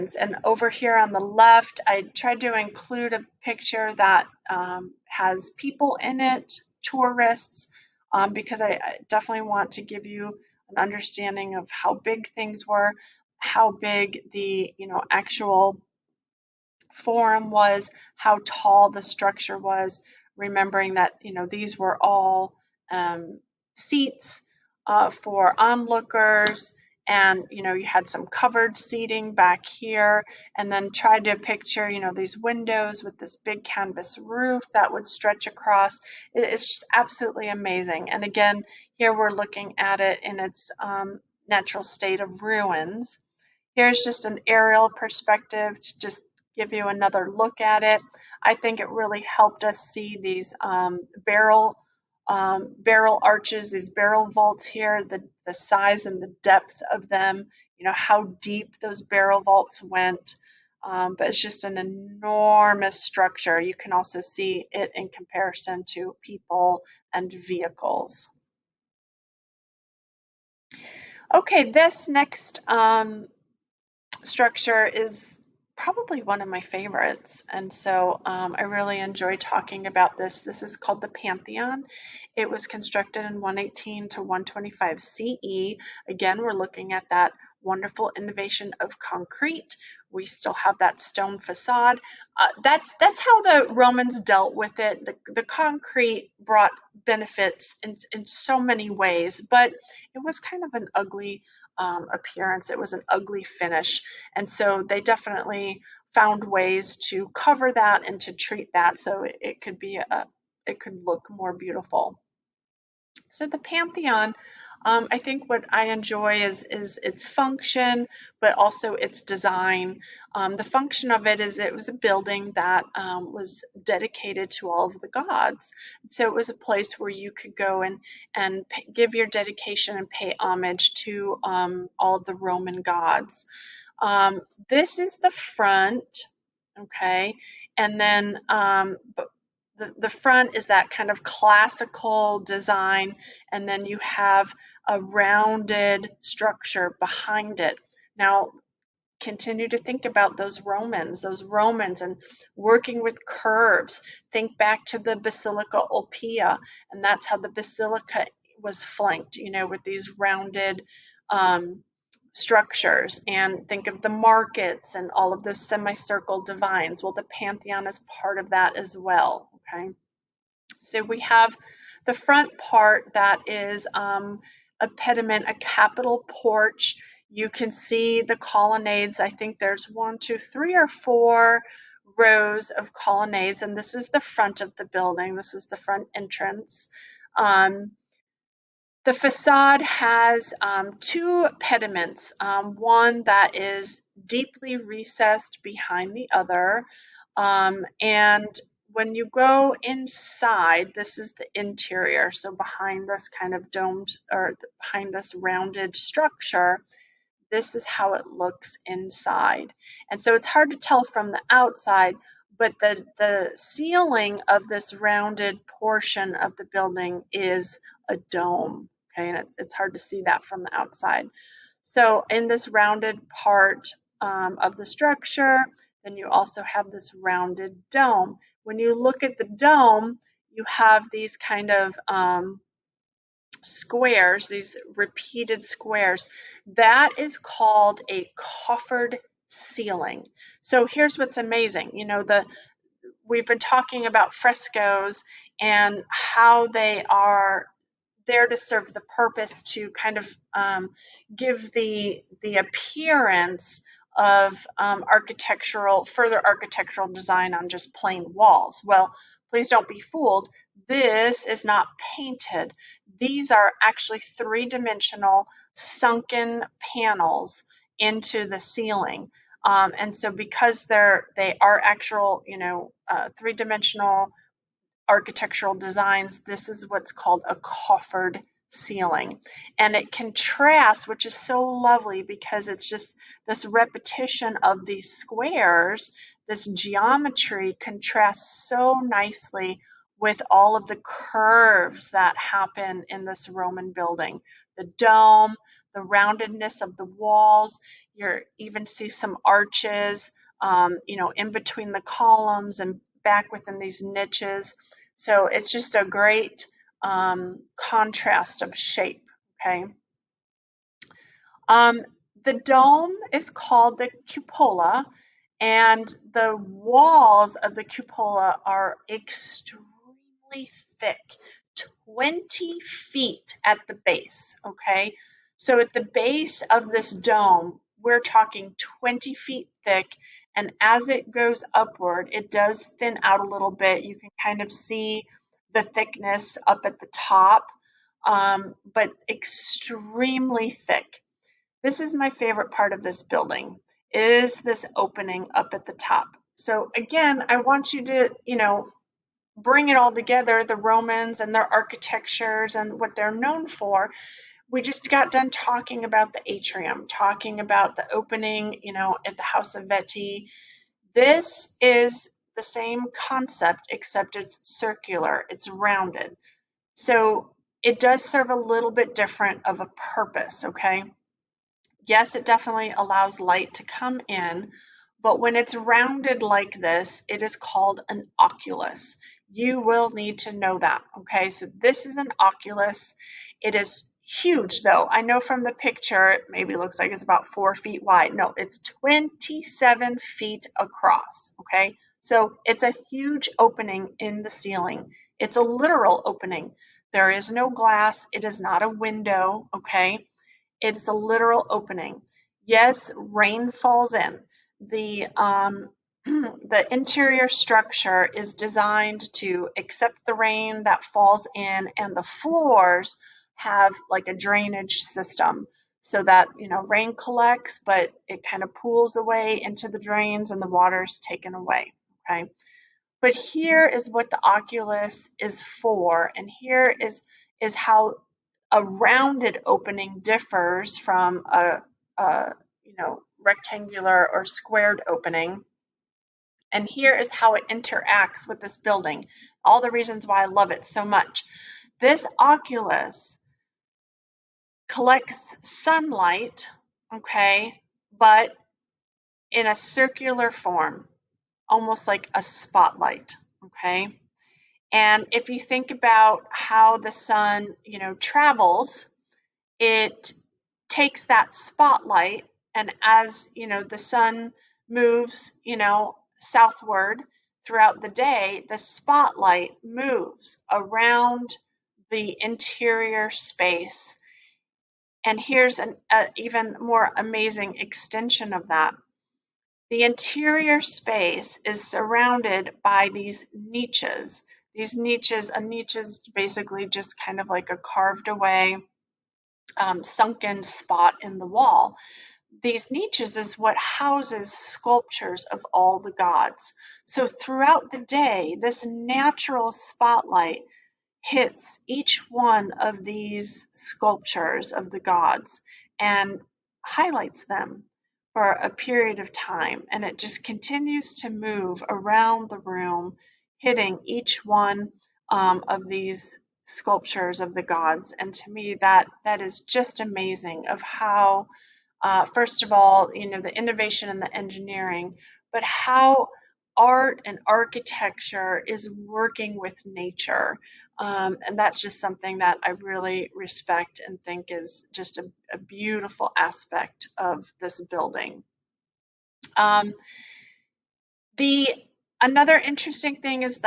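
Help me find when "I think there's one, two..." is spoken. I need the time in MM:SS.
02:59.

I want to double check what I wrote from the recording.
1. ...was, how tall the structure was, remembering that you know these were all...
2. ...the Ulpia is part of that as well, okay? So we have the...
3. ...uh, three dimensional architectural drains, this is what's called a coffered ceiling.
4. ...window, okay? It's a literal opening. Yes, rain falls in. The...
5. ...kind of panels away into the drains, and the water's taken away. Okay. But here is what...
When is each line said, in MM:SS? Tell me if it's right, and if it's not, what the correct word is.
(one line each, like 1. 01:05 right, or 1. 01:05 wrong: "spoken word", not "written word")
1. 00:17 right
2. 02:47 wrong: "Pantheon", not "Ulpia"
3. 04:33 wrong: "designs", not "drains"
4. 06:38 right
5. 06:58 wrong: "pools", not "panels".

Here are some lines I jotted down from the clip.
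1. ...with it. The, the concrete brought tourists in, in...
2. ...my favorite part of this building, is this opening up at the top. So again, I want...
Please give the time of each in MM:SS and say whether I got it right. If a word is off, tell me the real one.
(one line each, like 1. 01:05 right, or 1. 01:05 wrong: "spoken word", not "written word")
1. 01:34 wrong: "benefits", not "tourists"
2. 05:42 right.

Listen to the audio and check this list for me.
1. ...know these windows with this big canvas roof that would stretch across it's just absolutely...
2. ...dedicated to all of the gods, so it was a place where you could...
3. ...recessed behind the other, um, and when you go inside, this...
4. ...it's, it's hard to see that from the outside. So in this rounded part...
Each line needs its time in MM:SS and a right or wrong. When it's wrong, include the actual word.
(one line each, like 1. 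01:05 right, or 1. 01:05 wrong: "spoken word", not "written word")
1. 00:31 right
2. 02:03 right
3. 03:14 right
4. 03:39 right.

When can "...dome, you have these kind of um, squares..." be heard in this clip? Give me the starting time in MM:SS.
03:49.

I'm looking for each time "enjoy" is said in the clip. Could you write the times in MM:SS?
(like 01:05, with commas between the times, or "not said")
01:19, 01:55.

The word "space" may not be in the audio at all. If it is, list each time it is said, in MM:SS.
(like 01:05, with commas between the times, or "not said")
07:53, 08:00.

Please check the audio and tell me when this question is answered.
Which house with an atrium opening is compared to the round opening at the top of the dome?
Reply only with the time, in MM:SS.
05:59.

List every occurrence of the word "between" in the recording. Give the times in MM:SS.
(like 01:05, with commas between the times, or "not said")
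05:01.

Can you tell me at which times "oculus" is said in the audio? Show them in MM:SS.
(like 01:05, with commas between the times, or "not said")
06:18, 06:22, 07:04, 07:22.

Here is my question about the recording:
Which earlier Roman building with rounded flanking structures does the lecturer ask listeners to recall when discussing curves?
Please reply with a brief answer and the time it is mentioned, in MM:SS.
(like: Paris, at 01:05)
Basilica Ulpia, at 02:35.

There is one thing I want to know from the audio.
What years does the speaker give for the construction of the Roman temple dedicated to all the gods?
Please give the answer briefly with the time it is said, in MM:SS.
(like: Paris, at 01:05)
118 to 125 CE, at 01:23.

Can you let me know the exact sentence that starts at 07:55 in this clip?
And here's an a, even more amazing extension of that.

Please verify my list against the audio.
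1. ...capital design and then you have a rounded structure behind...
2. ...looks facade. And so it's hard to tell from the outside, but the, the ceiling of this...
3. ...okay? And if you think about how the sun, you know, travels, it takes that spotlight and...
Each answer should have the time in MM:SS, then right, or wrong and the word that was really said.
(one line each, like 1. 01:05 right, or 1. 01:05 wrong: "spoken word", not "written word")
1. 02:21 wrong: "classical", not "capital"
2. 03:28 wrong: "inside", not "facade"
3. 07:33 right.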